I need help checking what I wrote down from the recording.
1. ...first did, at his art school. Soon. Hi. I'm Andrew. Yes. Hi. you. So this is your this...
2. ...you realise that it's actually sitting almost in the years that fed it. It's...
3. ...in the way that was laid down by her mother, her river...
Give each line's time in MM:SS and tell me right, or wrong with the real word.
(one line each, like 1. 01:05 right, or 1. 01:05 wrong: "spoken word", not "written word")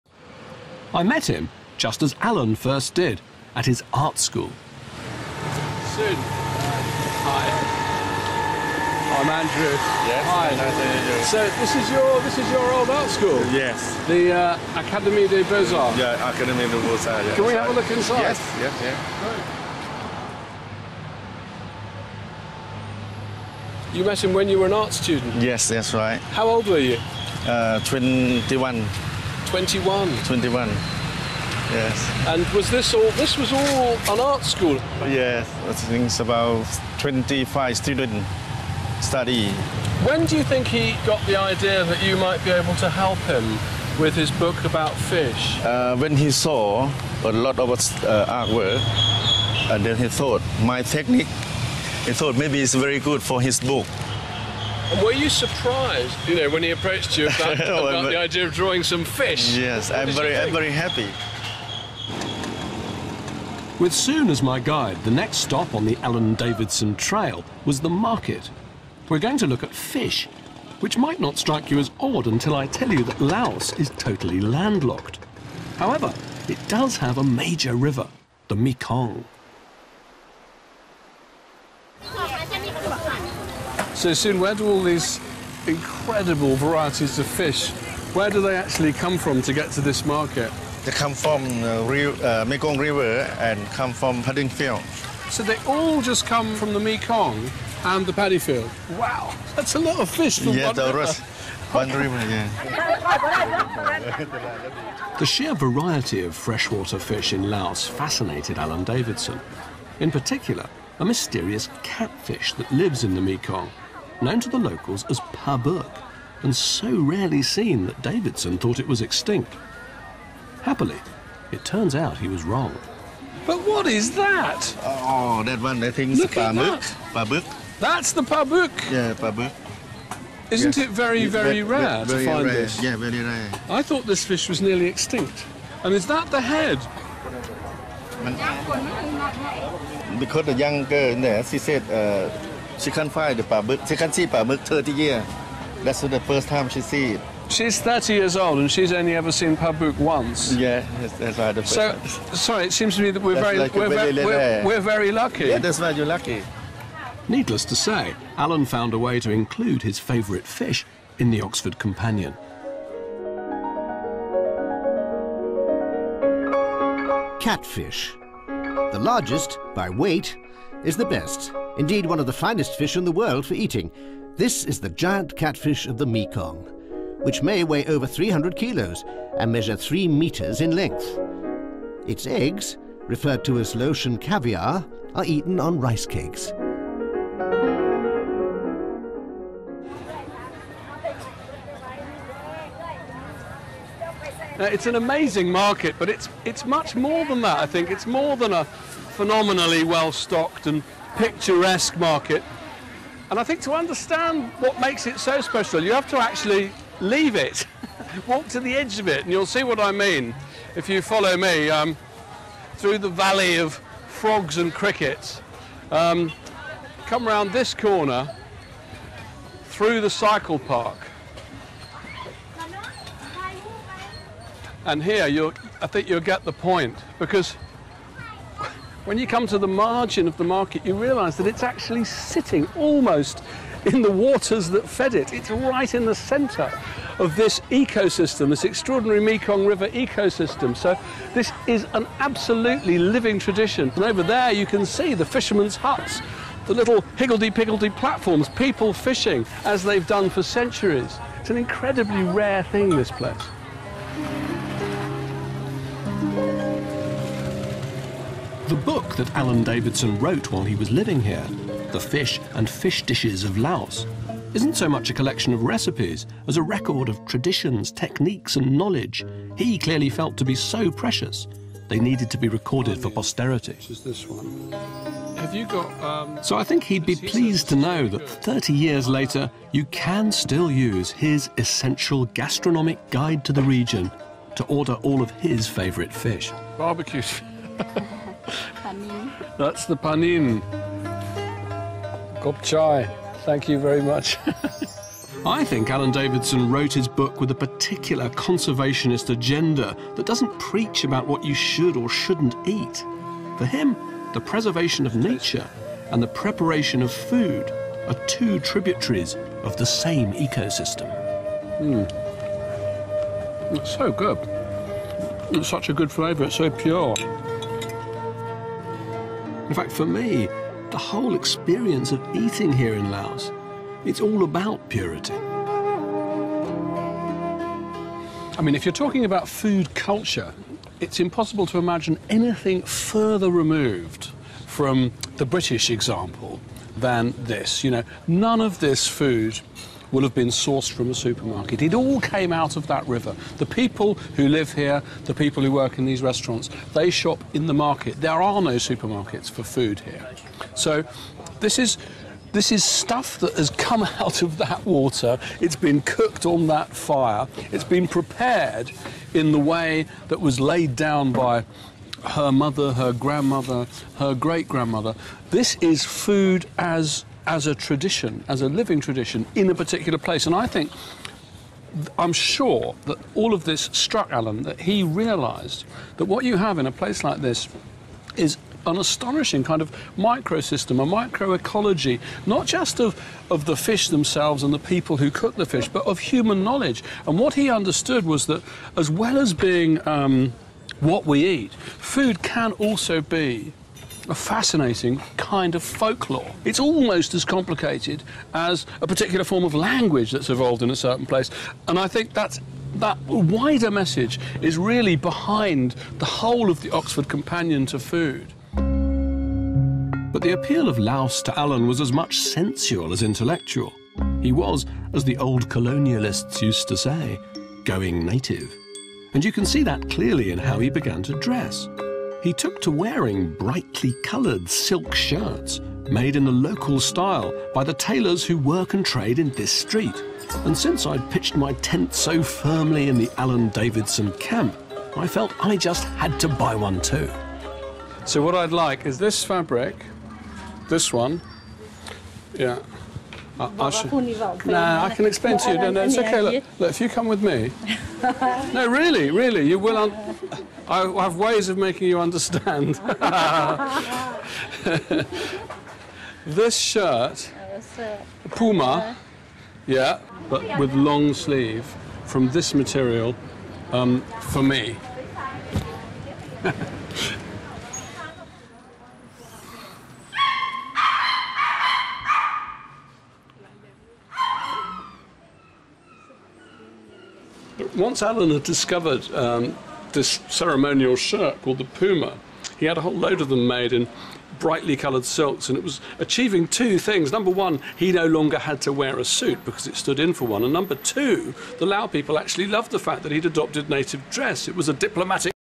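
1. 00:02 right
2. 03:50 wrong: "waters", not "years"
3. 05:59 wrong: "grandmother", not "river".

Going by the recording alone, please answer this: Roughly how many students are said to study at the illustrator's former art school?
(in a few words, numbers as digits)
25.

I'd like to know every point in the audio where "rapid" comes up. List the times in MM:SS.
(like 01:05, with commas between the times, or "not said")
not said.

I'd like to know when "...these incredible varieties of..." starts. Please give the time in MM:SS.
01:24.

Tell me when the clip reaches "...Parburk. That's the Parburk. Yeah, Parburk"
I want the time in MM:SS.
02:07.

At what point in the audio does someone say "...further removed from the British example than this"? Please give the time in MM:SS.
05:32.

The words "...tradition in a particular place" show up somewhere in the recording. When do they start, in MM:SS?
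06:08.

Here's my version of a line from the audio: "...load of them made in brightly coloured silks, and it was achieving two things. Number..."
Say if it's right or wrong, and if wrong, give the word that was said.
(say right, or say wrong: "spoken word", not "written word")
right.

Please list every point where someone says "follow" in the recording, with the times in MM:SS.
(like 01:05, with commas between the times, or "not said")
03:31.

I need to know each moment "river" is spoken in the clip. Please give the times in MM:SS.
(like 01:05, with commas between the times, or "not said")
01:17, 01:32, 01:40, 03:59, 05:43.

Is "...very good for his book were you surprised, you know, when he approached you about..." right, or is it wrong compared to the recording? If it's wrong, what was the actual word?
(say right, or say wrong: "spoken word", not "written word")
right.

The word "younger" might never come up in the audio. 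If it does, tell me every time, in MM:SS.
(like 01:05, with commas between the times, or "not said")
02:20.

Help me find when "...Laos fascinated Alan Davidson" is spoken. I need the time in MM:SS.
01:47.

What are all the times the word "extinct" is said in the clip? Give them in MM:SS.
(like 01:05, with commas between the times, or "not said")
01:59, 02:14.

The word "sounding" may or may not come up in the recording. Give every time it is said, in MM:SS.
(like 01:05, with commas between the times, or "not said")
not said.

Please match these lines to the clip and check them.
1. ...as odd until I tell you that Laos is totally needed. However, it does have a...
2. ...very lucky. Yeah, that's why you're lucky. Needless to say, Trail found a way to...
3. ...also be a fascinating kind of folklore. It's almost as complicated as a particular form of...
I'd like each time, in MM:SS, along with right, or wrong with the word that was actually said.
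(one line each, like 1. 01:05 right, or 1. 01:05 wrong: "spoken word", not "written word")
1. 01:11 wrong: "landlocked", not "needed"
2. 02:34 wrong: "Alan", not "Trail"
3. 06:32 right.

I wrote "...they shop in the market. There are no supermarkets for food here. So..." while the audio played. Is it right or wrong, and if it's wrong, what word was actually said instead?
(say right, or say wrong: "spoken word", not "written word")
right.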